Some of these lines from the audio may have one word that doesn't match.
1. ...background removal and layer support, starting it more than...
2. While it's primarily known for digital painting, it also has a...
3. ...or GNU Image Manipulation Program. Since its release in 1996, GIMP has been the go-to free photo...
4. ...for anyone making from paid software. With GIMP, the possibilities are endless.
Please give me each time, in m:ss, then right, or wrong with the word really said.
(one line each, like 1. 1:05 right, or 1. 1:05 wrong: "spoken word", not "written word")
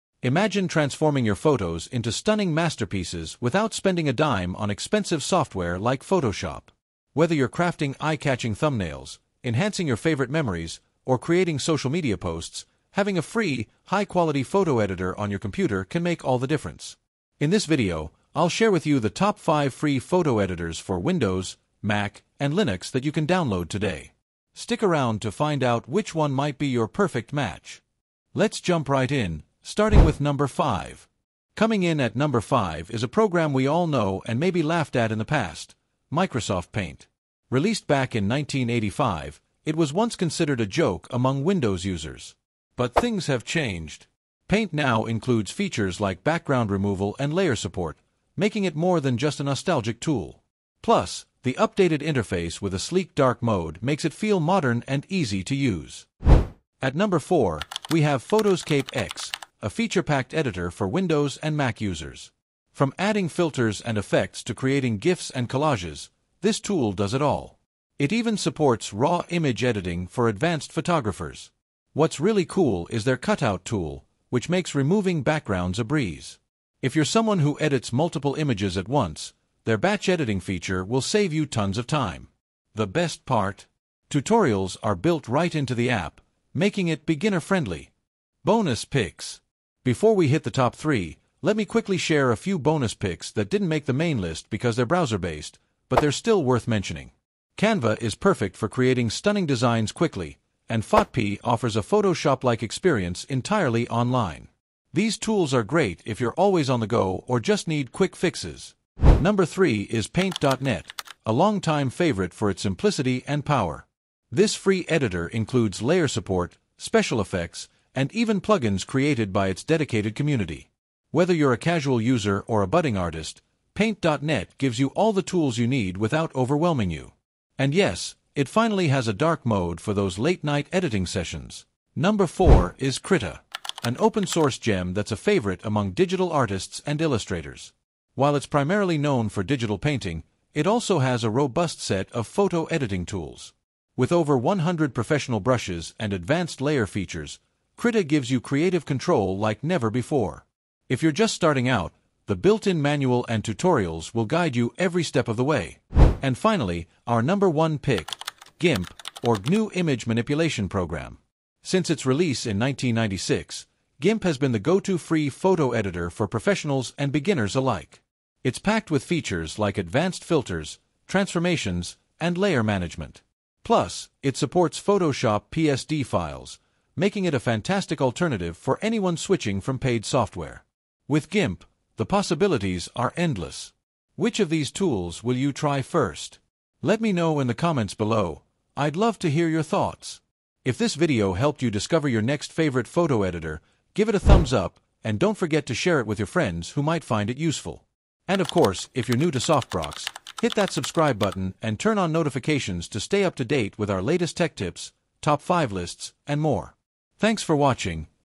1. 0:46 wrong: "making", not "starting"
2. 2:18 right
3. 2:39 right
4. 2:58 wrong: "switching", not "making".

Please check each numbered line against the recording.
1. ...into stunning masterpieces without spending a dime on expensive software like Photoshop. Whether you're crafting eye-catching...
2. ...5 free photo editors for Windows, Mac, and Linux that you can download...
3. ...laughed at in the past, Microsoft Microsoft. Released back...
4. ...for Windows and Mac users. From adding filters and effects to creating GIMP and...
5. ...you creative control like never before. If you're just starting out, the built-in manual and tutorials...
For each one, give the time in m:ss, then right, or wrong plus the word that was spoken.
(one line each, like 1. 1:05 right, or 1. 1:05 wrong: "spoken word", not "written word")
1. 0:01 right
2. 0:19 right
3. 0:34 wrong: "Paint", not "Microsoft"
4. 1:00 wrong: "GIFs", not "GIMP"
5. 2:28 right.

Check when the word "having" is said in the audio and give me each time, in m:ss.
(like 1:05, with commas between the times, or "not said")
0:12.